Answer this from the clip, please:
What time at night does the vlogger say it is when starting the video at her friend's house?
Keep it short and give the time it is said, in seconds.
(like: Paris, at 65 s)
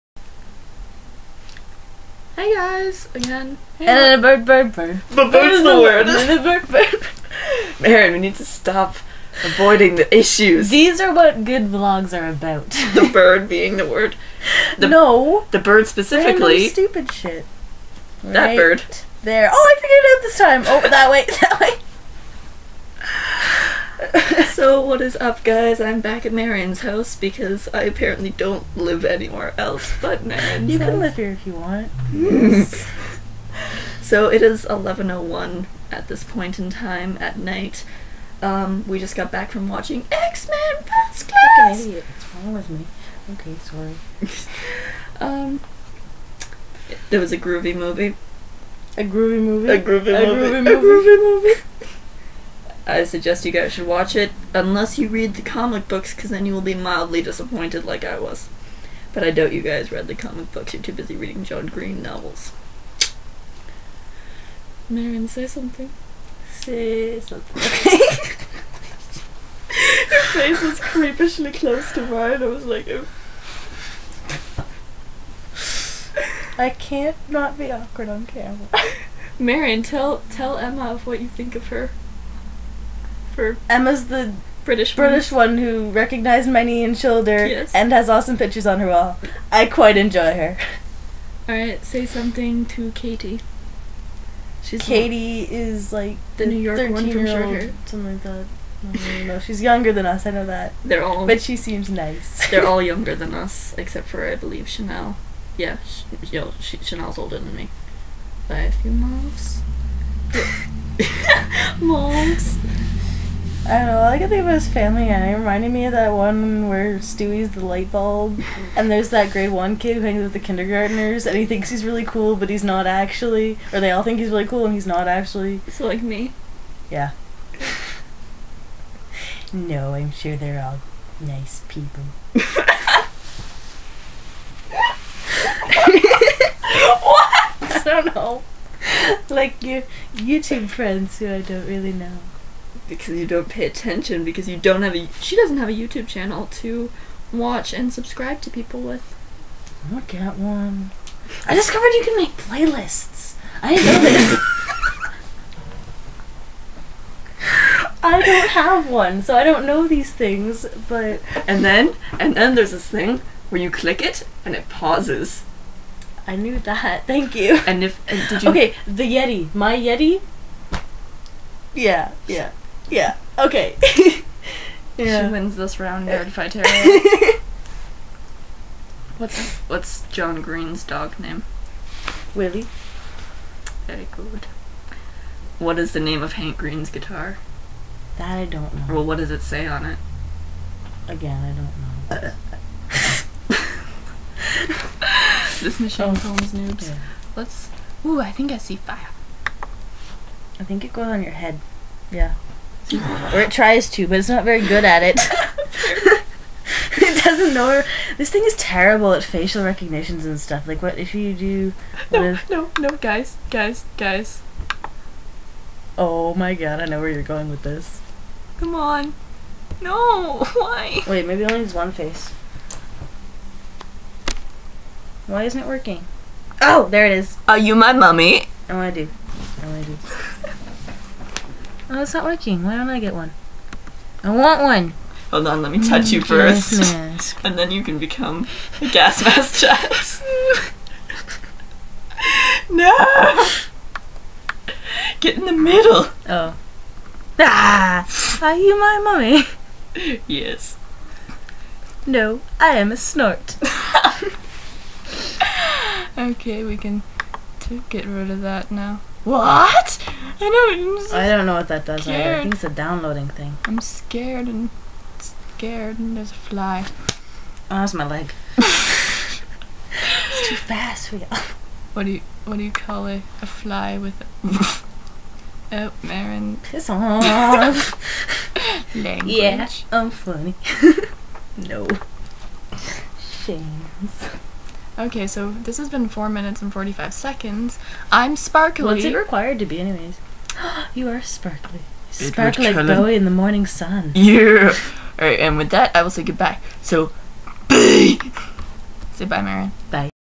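11.01, at 34 s.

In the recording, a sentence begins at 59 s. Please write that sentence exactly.
But I doubt you guys read the comic books, you're too busy reading John Green novels.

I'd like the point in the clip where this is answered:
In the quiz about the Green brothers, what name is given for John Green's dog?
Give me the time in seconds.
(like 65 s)
182 s.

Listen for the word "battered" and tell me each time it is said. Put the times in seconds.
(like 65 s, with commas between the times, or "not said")
not said.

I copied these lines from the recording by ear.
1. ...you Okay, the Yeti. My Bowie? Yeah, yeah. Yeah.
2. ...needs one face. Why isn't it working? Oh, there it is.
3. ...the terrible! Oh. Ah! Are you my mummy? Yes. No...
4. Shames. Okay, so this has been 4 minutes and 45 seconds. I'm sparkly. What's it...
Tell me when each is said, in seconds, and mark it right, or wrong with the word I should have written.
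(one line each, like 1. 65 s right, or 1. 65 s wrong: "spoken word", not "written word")
1. 168 s wrong: "Yeti", not "Bowie"
2. 221 s right
3. 245 s wrong: "middle", not "terrible"
4. 283 s right.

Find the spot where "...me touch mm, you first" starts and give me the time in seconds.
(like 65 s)
235 s.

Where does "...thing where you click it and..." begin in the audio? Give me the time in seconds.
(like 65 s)
162 s.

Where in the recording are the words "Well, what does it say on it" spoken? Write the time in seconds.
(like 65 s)
188 s.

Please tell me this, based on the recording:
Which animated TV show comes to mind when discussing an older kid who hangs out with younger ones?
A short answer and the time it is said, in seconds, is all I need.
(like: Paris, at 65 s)
Family Guy, at 114 s.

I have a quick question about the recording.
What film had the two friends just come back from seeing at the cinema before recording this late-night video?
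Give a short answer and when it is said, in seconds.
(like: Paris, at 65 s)
X-Men First Class, at 40 s.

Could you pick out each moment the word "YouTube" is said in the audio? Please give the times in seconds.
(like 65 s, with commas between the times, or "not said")
140 s, 145 s.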